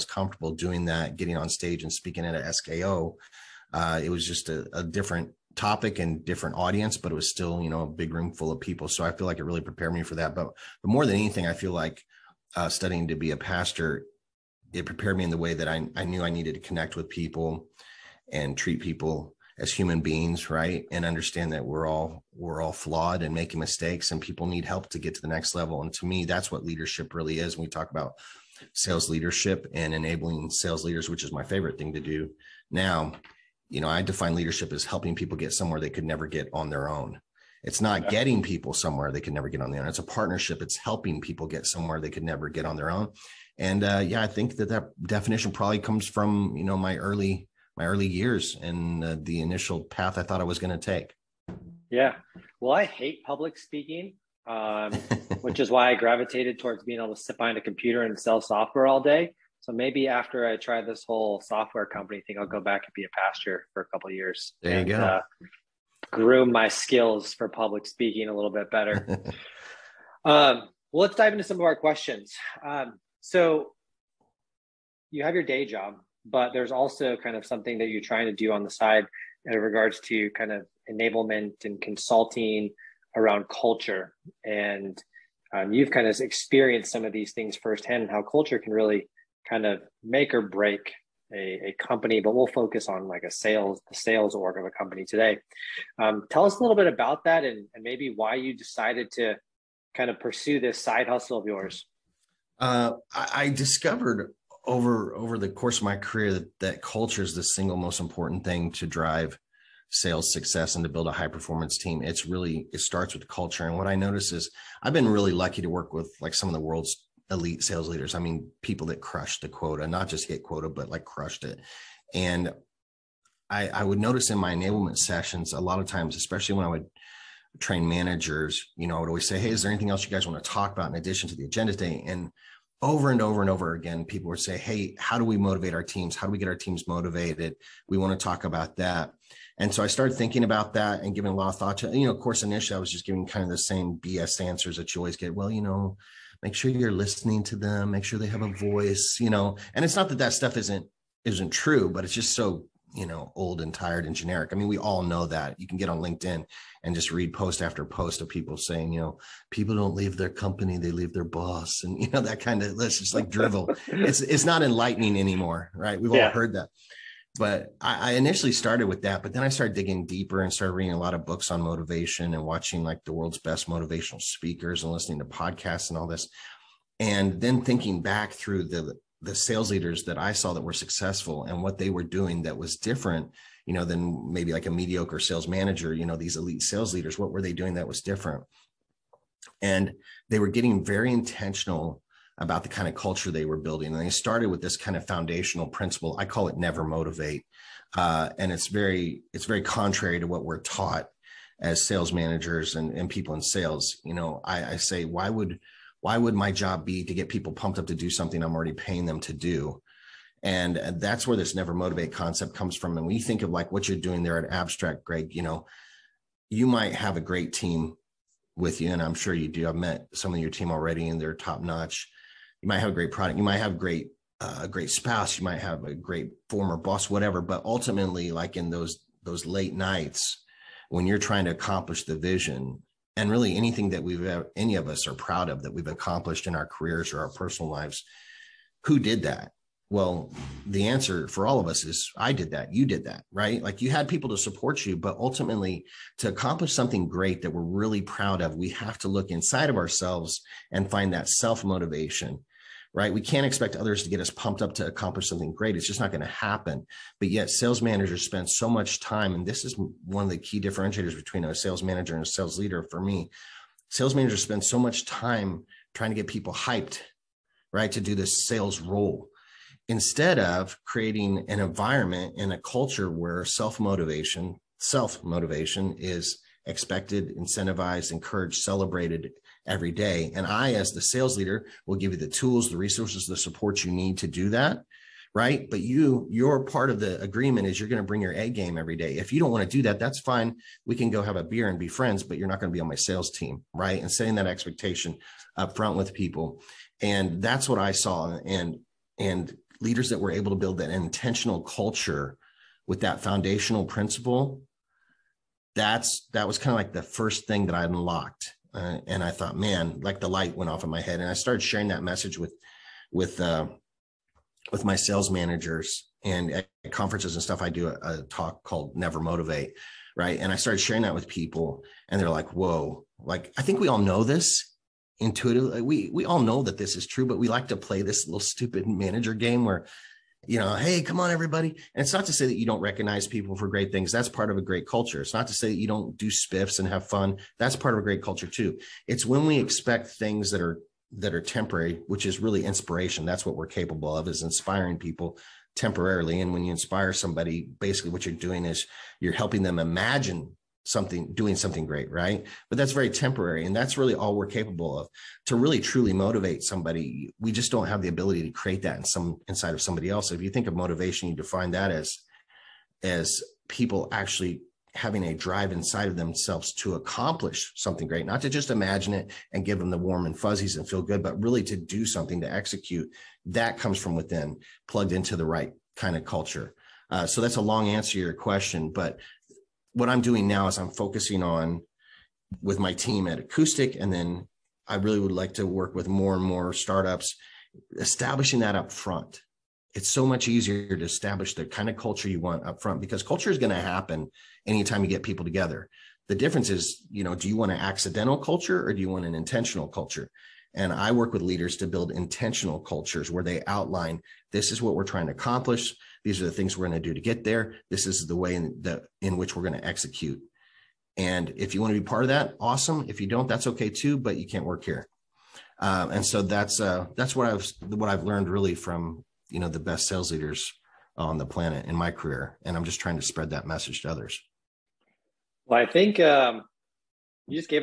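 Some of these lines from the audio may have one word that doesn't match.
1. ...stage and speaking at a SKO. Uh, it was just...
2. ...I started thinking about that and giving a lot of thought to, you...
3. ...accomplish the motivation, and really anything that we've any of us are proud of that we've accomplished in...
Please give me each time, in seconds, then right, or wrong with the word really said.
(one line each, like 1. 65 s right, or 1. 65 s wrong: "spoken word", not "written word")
1. 1 s right
2. 139 s right
3. 231 s wrong: "vision", not "motivation".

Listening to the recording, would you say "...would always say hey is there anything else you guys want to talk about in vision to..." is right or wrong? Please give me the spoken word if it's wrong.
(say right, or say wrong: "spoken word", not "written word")
wrong: "addition", not "vision".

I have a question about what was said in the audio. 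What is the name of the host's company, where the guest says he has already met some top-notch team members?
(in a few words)
Abstrakt.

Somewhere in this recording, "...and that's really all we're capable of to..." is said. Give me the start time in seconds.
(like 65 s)
353 s.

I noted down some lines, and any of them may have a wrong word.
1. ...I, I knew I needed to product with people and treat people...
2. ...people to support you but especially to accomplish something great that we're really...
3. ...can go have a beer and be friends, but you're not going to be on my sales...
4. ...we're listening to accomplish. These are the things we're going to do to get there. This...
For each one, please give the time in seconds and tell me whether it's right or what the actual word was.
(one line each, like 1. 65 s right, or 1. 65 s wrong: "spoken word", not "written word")
1. 15 s wrong: "connect", not "product"
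2. 244 s wrong: "ultimately", not "especially"
3. 290 s right
4. 404 s wrong: "trying", not "listening".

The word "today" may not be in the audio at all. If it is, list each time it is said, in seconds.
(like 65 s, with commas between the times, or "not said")
95 s, 131 s.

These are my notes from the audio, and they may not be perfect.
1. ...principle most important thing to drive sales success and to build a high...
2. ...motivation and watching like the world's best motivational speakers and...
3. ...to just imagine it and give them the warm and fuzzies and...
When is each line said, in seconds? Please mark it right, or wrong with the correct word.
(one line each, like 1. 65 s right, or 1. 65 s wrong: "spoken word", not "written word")
1. 107 s wrong: "single", not "principle"
2. 171 s right
3. 368 s right.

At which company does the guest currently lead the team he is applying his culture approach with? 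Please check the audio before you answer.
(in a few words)
Acoustic.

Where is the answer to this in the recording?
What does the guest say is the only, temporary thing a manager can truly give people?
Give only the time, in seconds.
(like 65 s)
342 s.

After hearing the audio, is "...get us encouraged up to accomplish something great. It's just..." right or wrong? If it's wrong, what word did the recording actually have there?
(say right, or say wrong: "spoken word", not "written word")
wrong: "pumped", not "encouraged".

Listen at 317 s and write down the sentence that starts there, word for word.
I do a, a talk called Never Motivate, right?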